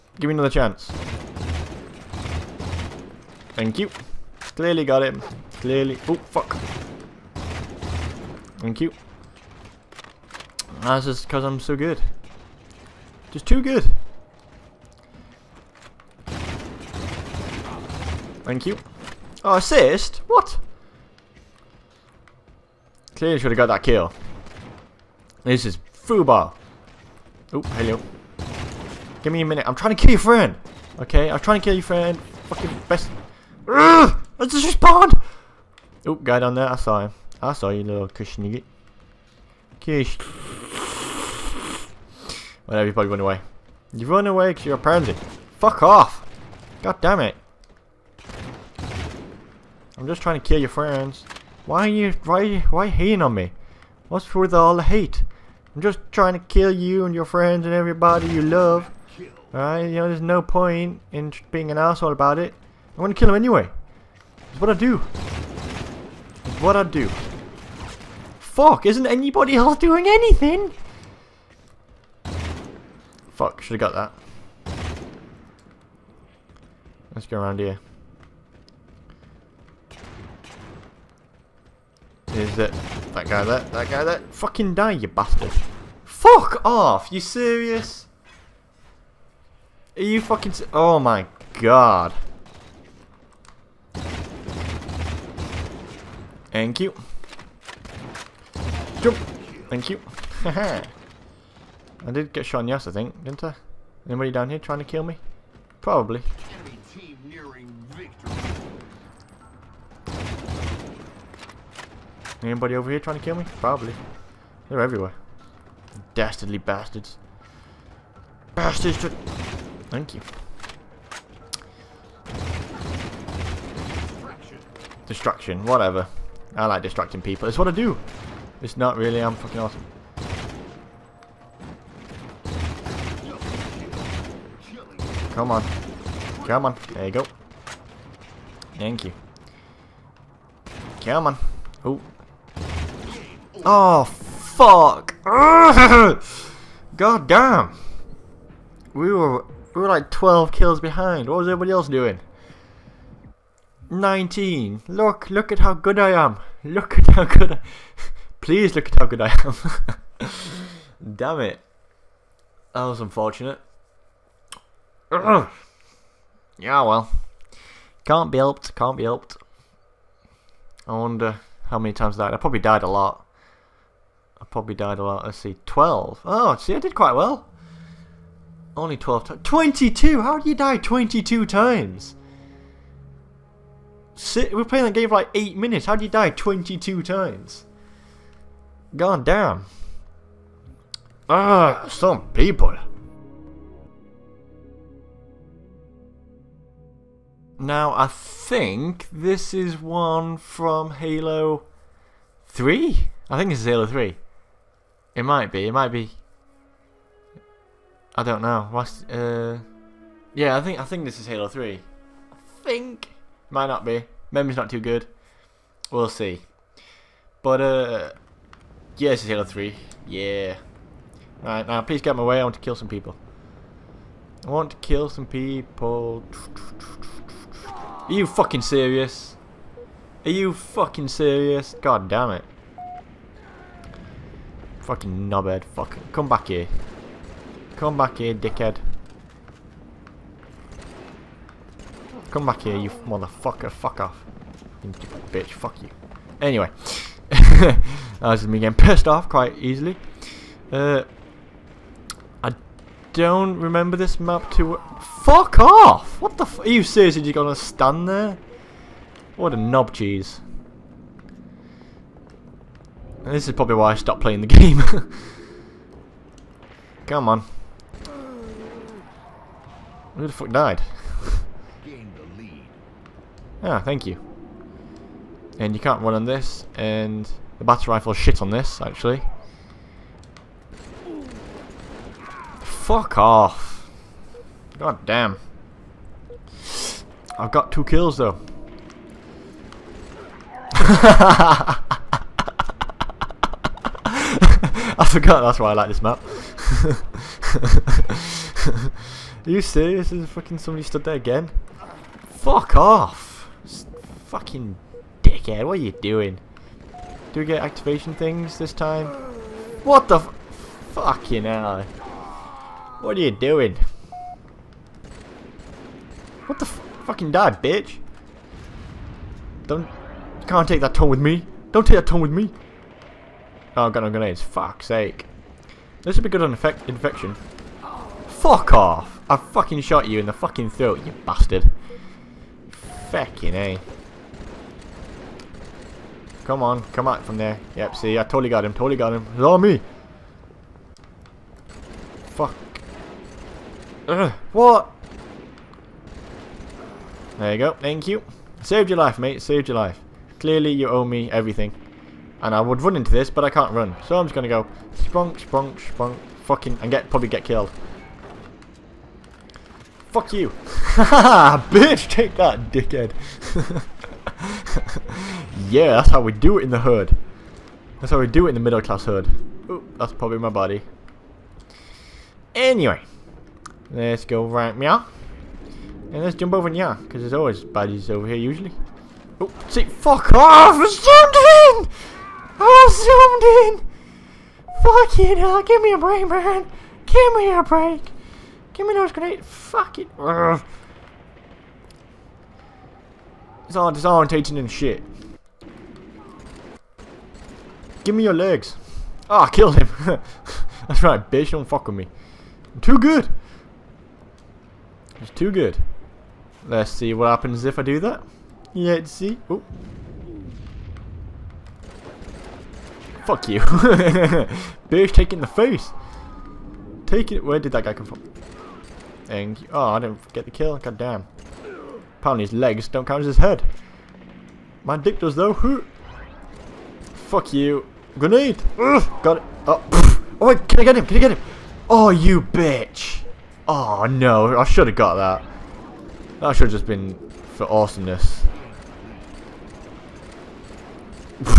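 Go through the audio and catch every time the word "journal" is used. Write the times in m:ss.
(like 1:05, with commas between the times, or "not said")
not said.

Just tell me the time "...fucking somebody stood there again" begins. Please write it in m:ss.
5:00.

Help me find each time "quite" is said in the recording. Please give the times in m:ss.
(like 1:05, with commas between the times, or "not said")
2:56, 4:09.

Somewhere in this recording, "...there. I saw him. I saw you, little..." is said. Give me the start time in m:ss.
0:36.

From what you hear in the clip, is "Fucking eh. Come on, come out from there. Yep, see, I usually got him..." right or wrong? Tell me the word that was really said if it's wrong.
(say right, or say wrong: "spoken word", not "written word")
wrong: "totally", not "usually".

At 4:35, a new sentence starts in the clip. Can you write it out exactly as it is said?
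And you can't run on this, and the battle rifle shit on this, actually.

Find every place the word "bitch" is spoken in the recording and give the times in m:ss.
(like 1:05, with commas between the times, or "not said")
4:05, 5:17, 6:01, 6:41, 6:54, 7:12.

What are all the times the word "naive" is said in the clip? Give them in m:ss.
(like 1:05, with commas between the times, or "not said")
not said.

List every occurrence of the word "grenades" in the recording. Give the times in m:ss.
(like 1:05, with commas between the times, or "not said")
5:24, 6:29, 7:08.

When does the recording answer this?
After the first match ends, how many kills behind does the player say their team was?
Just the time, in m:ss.
2:30.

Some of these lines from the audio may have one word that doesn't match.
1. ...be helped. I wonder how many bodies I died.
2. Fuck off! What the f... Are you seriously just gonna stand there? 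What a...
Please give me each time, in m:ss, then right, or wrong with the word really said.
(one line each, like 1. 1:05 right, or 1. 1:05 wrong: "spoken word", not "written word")
1. 2:48 wrong: "times", not "bodies"
2. 4:15 right.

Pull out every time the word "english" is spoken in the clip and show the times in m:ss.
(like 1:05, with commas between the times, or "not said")
not said.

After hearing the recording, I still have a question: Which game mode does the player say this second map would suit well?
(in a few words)
Infection.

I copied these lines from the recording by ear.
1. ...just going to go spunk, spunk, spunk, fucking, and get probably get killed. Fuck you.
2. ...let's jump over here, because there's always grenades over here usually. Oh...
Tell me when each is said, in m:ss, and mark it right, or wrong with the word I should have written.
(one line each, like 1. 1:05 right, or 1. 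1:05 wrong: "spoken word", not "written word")
1. 5:54 right
2. 6:16 wrong: "bodies", not "grenades".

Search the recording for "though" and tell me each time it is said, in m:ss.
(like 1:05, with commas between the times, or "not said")
4:48, 7:05.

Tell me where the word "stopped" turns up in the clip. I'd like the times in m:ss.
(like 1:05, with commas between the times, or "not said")
4:23.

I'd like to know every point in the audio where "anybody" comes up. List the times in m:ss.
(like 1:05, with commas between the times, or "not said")
1:09, 1:44, 1:52.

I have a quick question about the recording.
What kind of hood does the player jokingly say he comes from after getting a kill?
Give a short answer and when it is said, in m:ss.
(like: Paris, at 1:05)
middle class hood, at 6:08.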